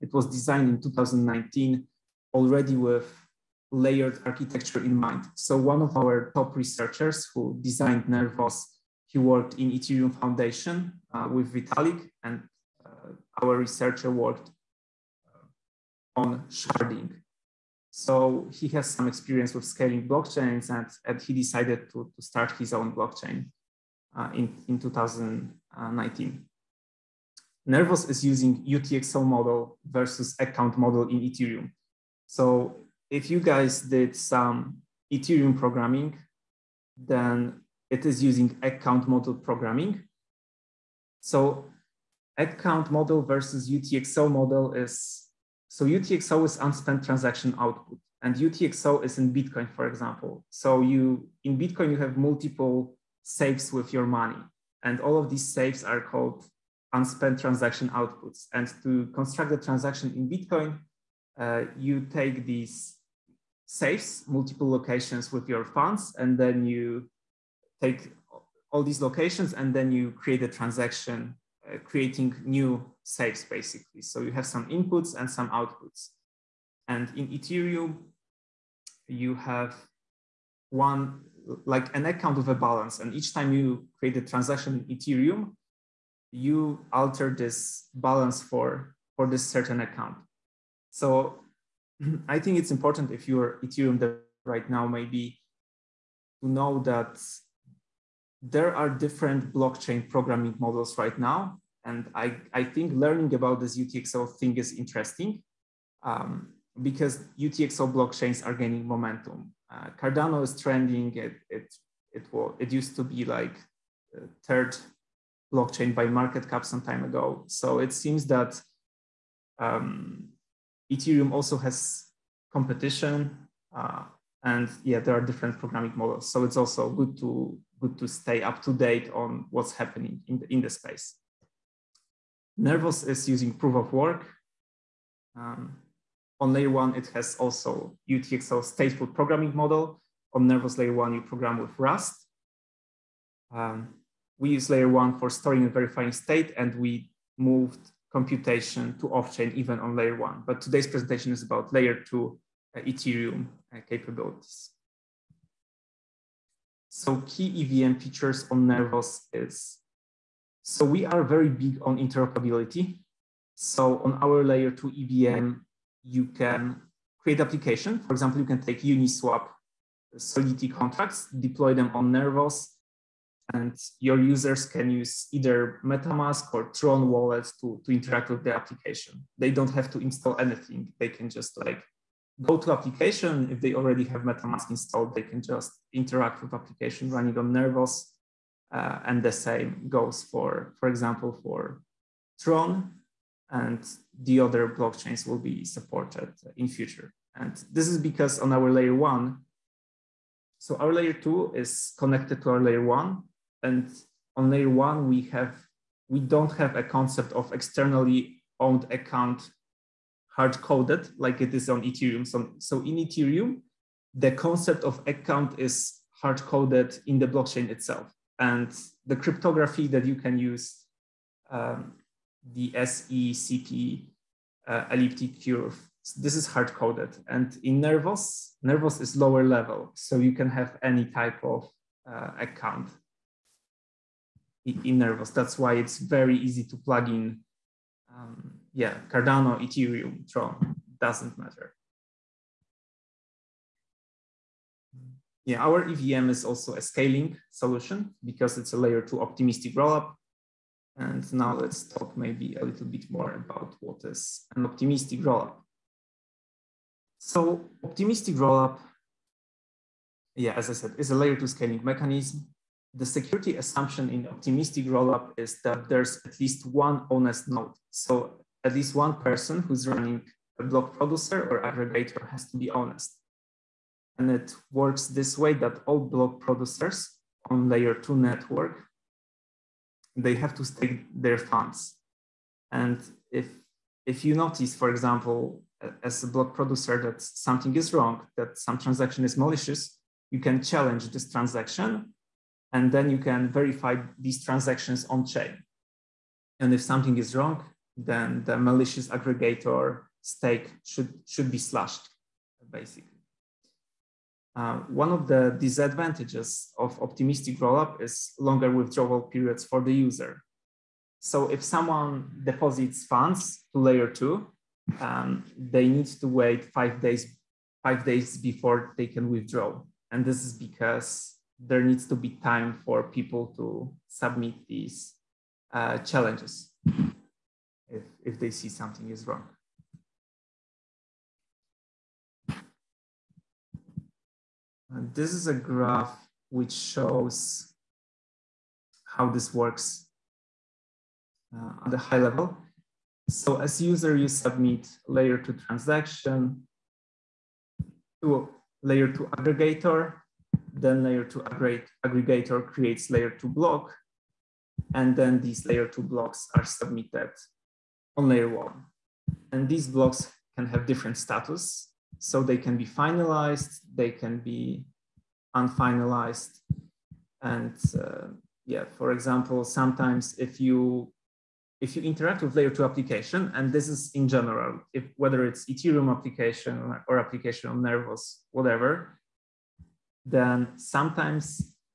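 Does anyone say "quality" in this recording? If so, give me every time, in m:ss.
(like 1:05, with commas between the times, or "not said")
not said.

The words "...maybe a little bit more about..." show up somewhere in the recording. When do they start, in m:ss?
4:12.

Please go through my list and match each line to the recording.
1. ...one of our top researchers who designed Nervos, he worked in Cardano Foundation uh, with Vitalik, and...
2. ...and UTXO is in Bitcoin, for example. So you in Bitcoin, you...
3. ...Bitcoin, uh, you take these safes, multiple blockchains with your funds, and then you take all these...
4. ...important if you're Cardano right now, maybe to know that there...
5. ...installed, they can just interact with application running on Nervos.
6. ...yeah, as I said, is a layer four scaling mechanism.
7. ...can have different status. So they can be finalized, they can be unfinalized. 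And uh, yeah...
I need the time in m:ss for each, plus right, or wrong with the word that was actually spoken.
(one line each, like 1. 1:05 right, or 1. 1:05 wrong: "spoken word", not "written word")
1. 0:05 wrong: "Ethereum", not "Cardano"
2. 0:48 right
3. 1:00 wrong: "locations", not "blockchains"
4. 1:32 wrong: "Ethereum", not "Cardano"
5. 3:04 right
6. 4:20 wrong: "two", not "four"
7. 6:00 right.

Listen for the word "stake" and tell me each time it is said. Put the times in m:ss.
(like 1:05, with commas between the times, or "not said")
4:40, 5:00.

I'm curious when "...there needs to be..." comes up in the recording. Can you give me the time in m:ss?
5:21.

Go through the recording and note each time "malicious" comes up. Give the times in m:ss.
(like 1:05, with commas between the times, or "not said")
4:49, 4:58.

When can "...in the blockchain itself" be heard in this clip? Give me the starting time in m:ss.
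3:37.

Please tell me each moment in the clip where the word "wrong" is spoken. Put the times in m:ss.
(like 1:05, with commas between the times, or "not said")
4:47, 4:57, 5:29.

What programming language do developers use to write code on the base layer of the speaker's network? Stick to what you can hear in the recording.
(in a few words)
Rust.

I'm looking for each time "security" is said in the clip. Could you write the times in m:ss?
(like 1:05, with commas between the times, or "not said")
4:23.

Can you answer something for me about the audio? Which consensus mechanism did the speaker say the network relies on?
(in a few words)
Proof of work.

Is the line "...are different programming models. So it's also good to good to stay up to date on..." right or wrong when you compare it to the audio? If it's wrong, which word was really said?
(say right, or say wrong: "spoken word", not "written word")
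right.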